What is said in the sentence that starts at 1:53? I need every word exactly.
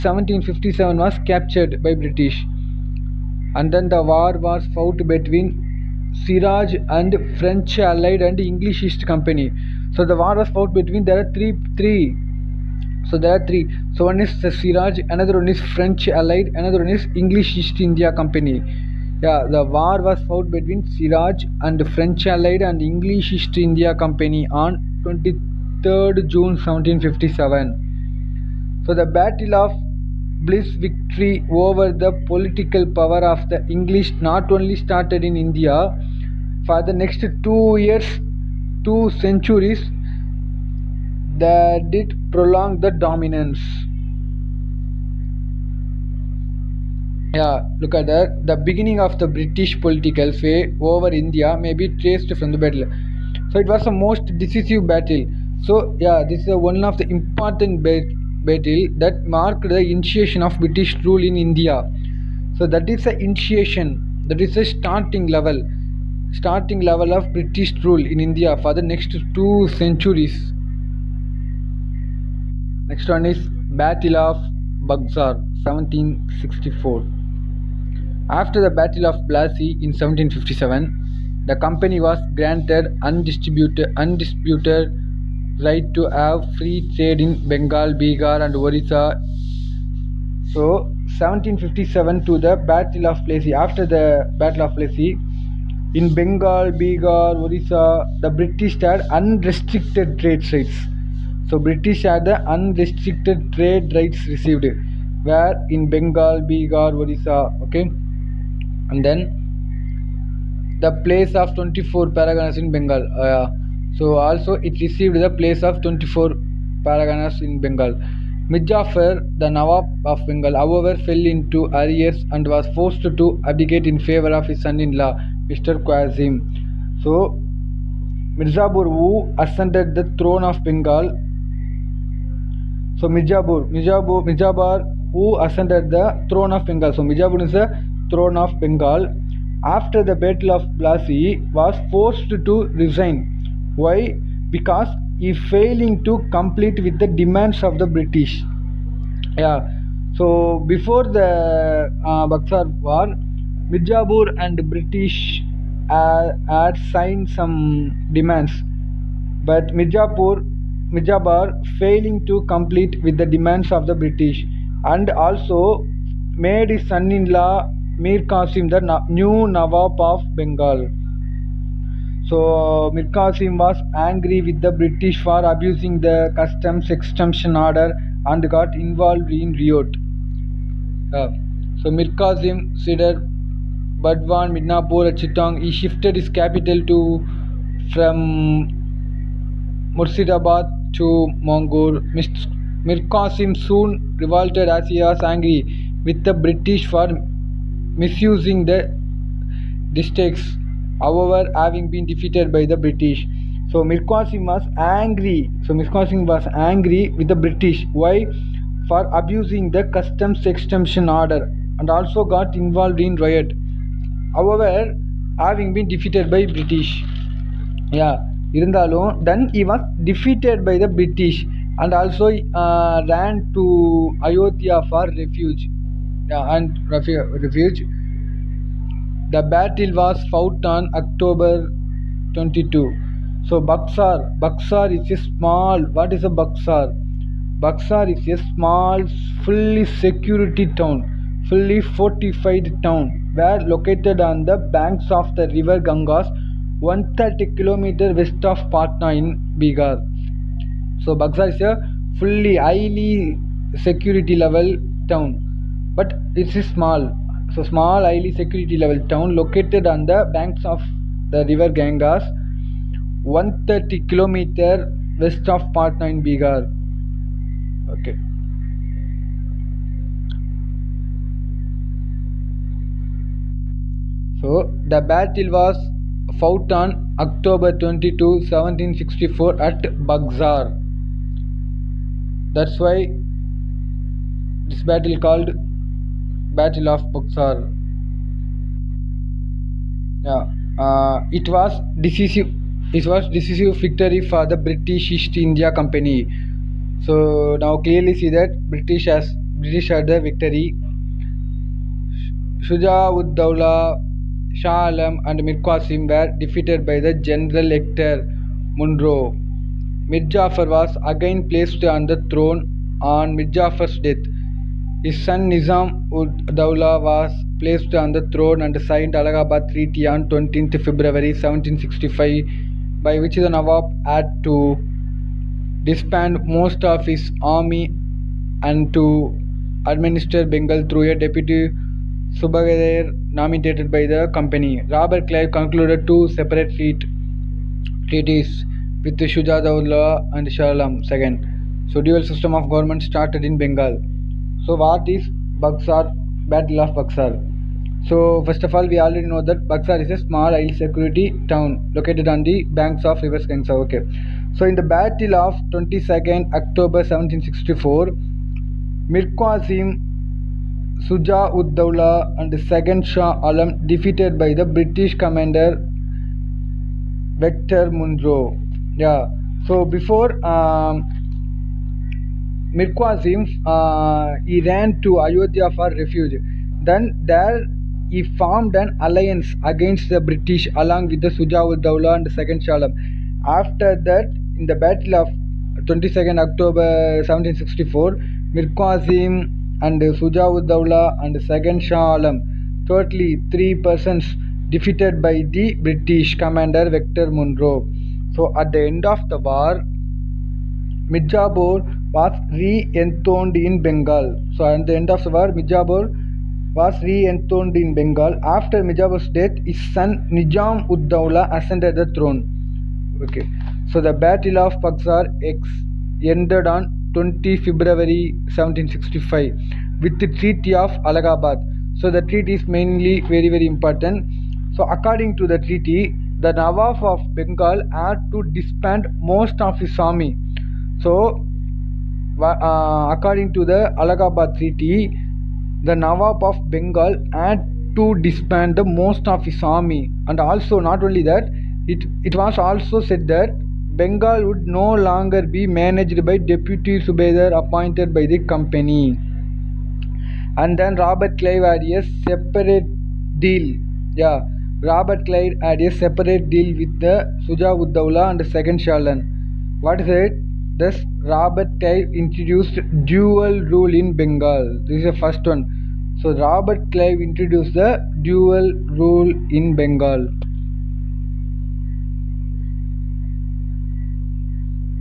Uh, so also it received the place of 24 paraganas in Bengal.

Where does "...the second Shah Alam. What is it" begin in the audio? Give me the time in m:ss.
7:38.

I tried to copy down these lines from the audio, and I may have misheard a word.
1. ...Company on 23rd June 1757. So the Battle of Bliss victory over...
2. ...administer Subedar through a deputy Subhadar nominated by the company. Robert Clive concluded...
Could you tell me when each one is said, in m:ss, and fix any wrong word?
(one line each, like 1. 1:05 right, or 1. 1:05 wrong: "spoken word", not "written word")
1. 0:23 right
2. 5:29 wrong: "Bengal", not "Subedar".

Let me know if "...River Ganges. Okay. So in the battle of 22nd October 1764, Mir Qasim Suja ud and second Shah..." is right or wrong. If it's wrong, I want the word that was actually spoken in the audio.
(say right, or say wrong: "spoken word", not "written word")
right.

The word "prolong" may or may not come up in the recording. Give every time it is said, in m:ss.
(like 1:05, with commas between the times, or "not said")
0:42.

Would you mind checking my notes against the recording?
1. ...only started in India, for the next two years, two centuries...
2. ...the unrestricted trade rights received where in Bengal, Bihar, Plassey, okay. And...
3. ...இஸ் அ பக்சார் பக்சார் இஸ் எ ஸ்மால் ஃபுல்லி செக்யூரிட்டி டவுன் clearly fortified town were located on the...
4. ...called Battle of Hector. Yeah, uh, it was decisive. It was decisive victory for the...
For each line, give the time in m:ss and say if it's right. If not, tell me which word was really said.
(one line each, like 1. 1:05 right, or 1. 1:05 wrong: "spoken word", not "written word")
1. 0:34 right
2. 1:42 wrong: "Orissa", not "Plassey"
3. 3:56 wrong: "fully", not "clearly"
4. 4:45 wrong: "Buxar", not "Hector".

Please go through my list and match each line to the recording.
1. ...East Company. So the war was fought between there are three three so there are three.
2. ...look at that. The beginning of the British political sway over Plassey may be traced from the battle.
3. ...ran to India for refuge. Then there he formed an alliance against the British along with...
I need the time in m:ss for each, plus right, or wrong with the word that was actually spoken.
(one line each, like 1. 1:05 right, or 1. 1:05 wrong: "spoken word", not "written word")
1. 0:08 right
2. 0:47 wrong: "India", not "Plassey"
3. 6:14 wrong: "Ayodhya", not "India".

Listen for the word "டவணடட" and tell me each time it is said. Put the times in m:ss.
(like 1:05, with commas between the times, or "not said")
3:52.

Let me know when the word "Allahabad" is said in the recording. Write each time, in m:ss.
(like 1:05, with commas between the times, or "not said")
5:19, 7:01, 7:14.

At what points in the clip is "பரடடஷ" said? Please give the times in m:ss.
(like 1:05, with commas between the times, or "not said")
3:40.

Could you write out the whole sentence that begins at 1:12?
Next one is Battle of Buxar 1764.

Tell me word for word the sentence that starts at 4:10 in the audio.
So Buxar is a fully highly security level town, but it is a small.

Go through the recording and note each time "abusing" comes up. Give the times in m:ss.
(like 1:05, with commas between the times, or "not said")
2:55, 3:29.